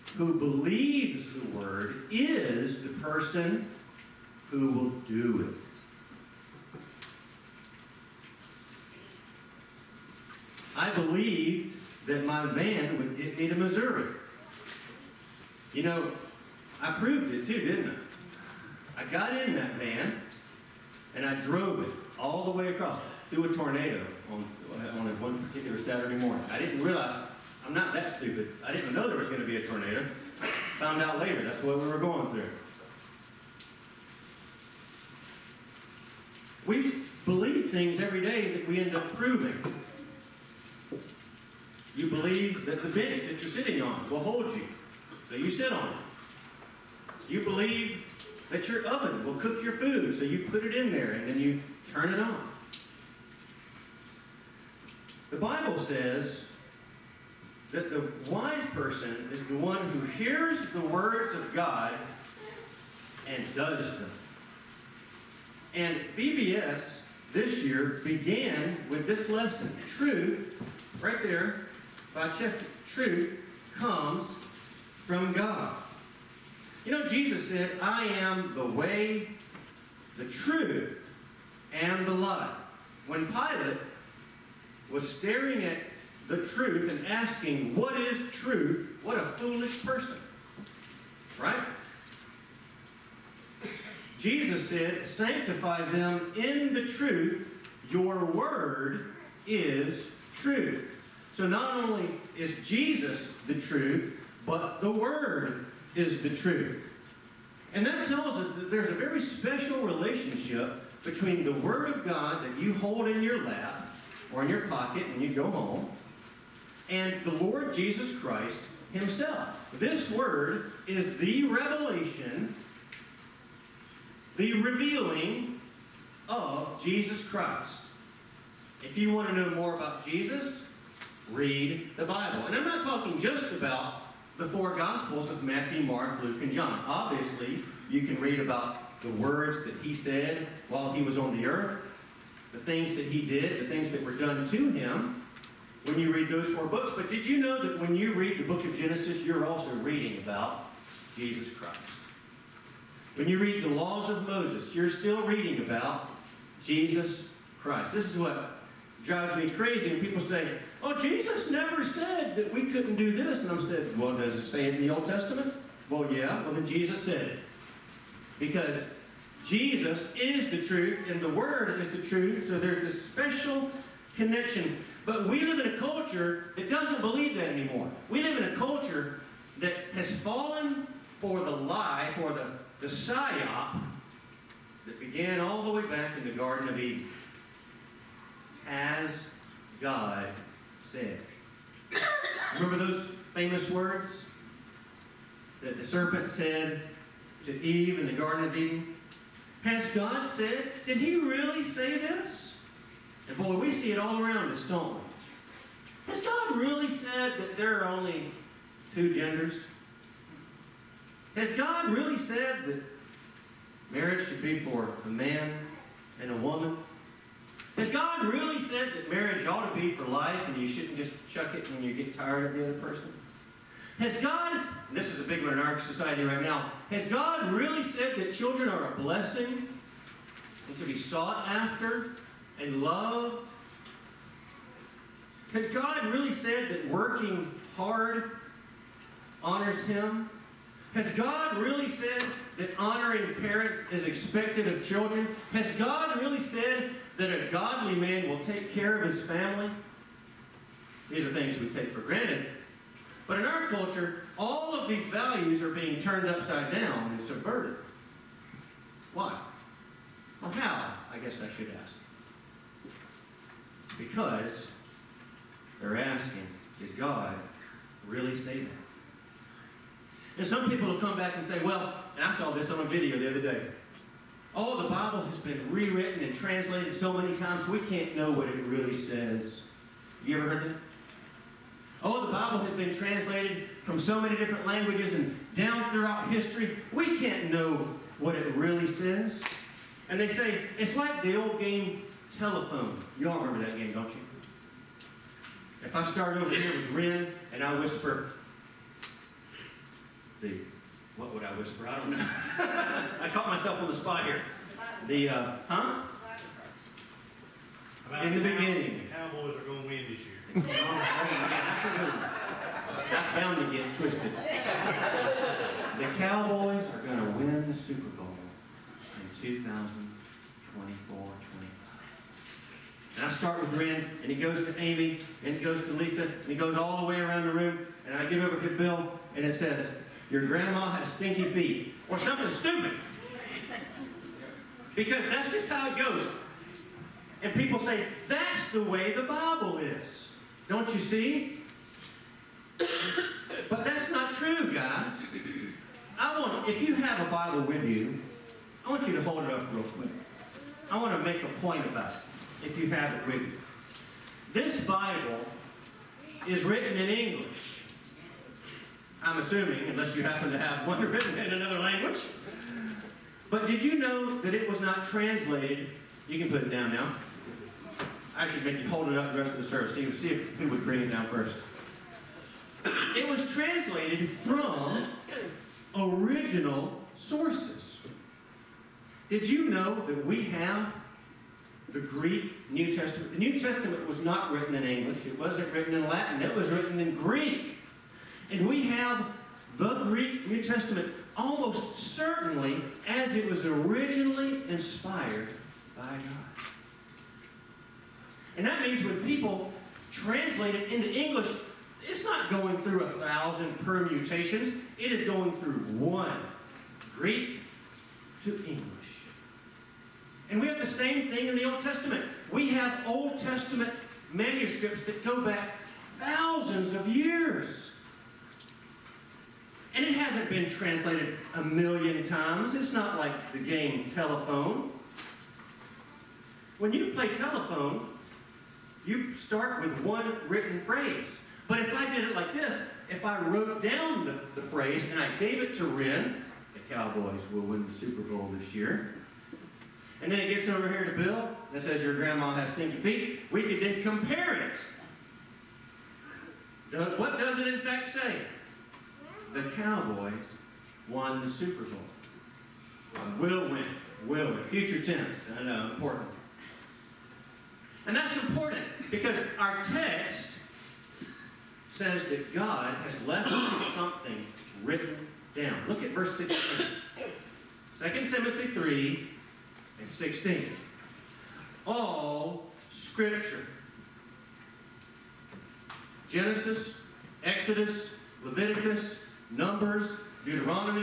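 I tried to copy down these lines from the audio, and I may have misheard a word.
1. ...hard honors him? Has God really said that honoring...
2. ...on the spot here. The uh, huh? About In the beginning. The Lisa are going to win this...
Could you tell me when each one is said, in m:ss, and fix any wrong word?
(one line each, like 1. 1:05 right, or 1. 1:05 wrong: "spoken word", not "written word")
1. 3:57 right
2. 5:03 wrong: "Cowboys", not "Lisa".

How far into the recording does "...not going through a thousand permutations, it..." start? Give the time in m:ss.
6:42.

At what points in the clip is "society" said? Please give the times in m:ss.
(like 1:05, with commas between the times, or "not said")
3:45.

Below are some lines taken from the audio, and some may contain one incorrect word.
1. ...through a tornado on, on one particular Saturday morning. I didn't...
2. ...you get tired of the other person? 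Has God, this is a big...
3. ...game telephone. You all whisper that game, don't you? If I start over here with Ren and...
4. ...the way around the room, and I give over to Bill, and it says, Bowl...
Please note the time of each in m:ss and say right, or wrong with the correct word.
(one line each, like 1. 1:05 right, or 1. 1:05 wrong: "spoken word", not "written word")
1. 0:23 right
2. 3:41 right
3. 4:51 wrong: "remember", not "whisper"
4. 5:26 wrong: "Your", not "Bowl".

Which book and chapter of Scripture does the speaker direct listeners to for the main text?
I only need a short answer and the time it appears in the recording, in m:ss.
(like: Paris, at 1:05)
2 Timothy 3, at 7:47.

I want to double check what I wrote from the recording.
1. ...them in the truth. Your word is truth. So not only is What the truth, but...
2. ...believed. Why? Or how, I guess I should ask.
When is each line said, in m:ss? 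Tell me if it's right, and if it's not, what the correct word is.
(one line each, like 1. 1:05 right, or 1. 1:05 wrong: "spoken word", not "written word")
1. 1:35 wrong: "Jesus", not "What"
2. 4:17 wrong: "subverted", not "believed".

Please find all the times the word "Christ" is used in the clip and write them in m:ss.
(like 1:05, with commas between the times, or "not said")
1:58, 2:07, 2:31, 2:37.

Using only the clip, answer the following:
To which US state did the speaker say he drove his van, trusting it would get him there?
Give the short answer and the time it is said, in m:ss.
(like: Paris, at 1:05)
Missouri, at 0:13.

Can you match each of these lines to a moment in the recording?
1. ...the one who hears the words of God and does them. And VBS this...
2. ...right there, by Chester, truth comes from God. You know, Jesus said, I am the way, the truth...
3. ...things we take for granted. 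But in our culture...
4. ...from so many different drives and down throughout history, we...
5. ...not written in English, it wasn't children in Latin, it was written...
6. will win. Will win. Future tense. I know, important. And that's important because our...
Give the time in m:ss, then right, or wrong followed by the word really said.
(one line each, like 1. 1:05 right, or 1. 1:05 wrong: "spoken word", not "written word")
1. 0:59 right
2. 1:11 right
3. 4:11 right
4. 4:43 wrong: "languages", not "drives"
5. 6:24 wrong: "written", not "children"
6. 7:33 right.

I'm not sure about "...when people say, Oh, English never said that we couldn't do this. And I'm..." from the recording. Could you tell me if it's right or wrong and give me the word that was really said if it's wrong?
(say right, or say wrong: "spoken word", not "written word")
wrong: "Jesus", not "English".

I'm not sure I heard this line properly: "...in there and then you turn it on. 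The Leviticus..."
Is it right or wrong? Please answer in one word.
wrong.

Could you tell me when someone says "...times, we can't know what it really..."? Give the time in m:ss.
4:37.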